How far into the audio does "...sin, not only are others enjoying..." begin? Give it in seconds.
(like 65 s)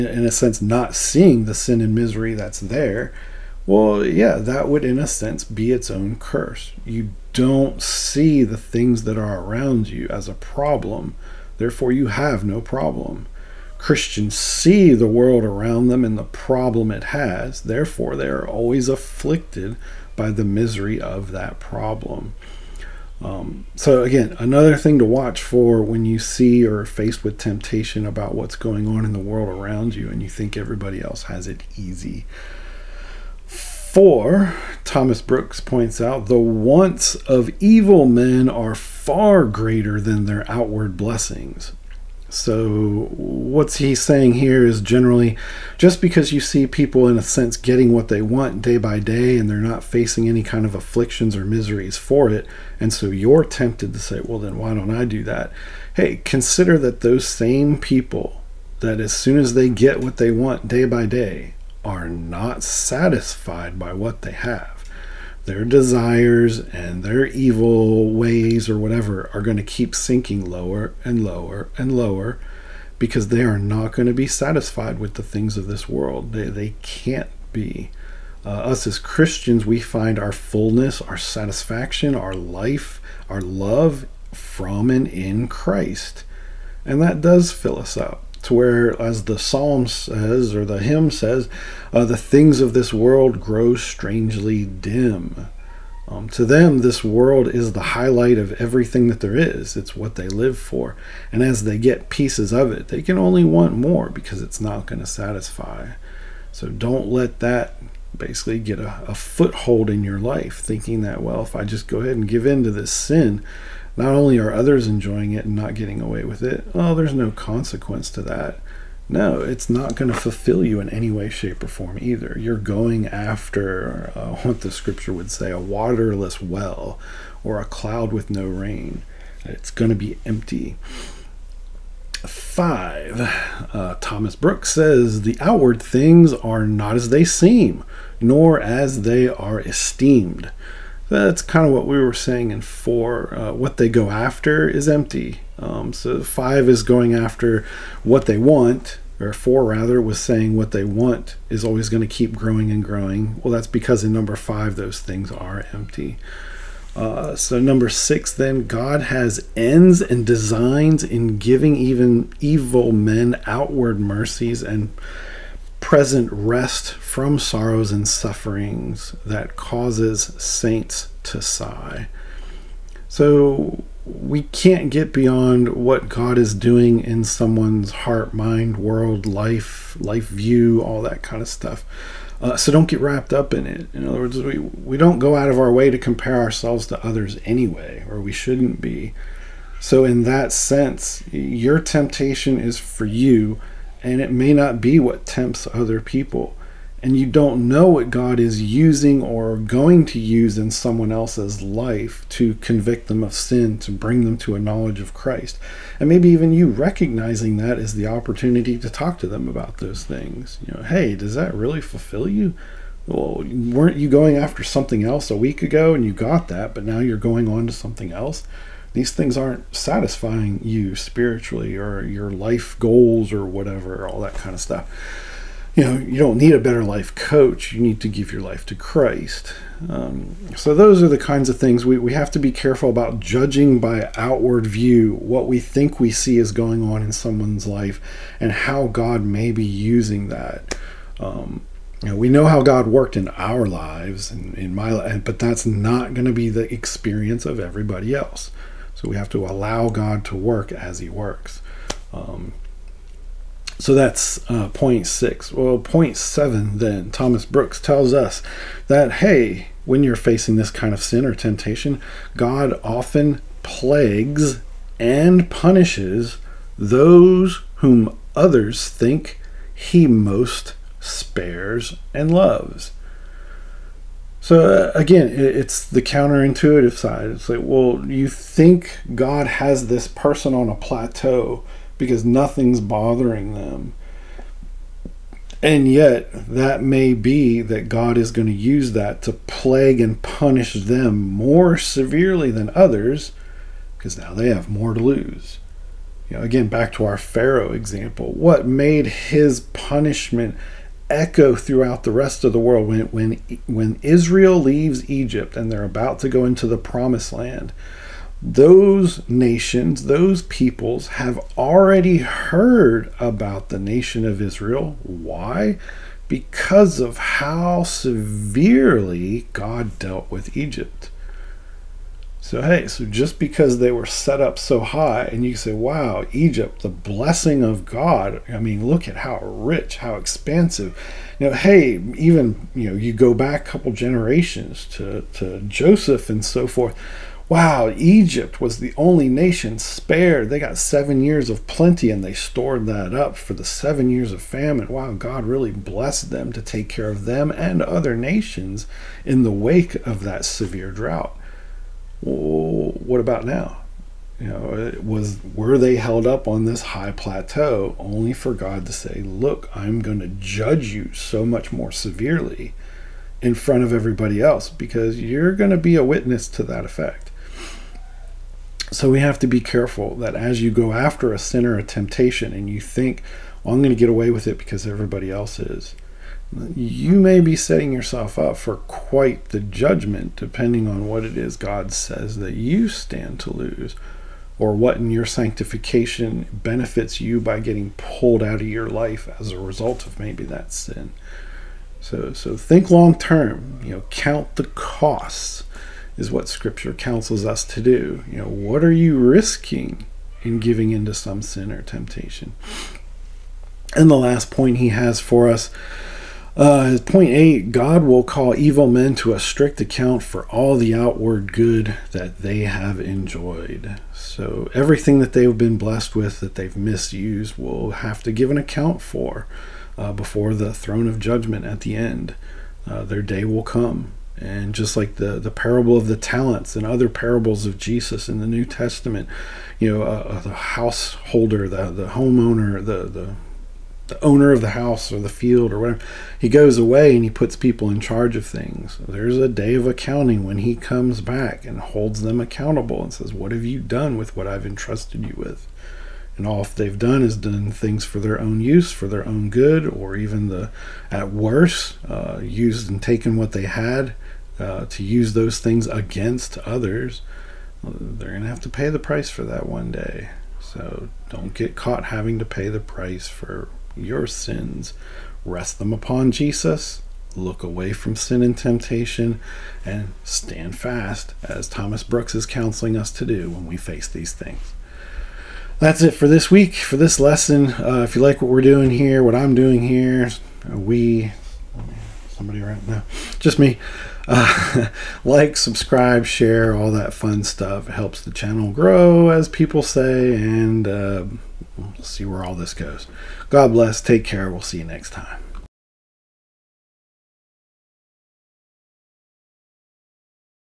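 112 s.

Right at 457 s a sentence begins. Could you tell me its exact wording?
Uh, they're going to have to pay the price for that one day.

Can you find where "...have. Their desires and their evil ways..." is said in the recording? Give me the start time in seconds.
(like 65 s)
64 s.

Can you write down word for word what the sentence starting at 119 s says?
No, it's not going to fulfill you in any way, shape, or form either.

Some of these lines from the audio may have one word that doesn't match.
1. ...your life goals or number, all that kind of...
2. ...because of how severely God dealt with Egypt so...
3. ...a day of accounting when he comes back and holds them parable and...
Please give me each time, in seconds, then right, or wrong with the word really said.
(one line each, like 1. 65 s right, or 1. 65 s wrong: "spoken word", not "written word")
1. 222 s wrong: "whatever", not "number"
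2. 316 s right
3. 439 s wrong: "accountable", not "parable".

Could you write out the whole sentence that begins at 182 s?
Uh, so don't get wrapped up in it.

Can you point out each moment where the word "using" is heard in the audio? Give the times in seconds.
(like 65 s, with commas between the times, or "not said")
198 s, 239 s.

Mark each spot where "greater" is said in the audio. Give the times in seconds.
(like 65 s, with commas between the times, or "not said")
39 s.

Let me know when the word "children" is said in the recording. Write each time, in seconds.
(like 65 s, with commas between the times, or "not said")
not said.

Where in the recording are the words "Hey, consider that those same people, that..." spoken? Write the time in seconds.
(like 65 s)
55 s.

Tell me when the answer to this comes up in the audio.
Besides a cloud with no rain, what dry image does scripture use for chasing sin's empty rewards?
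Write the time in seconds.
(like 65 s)
125 s.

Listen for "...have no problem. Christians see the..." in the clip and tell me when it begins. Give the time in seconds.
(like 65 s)
12 s.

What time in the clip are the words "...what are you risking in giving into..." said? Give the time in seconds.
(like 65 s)
398 s.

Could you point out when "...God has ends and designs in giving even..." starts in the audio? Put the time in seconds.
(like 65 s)
158 s.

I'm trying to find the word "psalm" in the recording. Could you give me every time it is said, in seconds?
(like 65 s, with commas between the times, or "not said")
89 s.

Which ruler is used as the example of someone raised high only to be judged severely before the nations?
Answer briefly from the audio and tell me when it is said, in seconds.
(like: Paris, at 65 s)
Pharaoh, at 297 s.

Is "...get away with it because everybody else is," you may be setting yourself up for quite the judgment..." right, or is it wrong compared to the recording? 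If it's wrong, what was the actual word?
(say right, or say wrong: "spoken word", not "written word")
right.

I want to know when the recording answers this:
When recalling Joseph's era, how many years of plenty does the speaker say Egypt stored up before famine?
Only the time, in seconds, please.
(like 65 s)
340 s.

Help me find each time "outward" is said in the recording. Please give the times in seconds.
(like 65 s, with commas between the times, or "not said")
40 s, 135 s, 163 s, 234 s, 410 s.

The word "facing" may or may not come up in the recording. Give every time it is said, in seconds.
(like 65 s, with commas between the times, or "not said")
49 s, 260 s.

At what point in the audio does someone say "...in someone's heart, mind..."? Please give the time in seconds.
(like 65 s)
177 s.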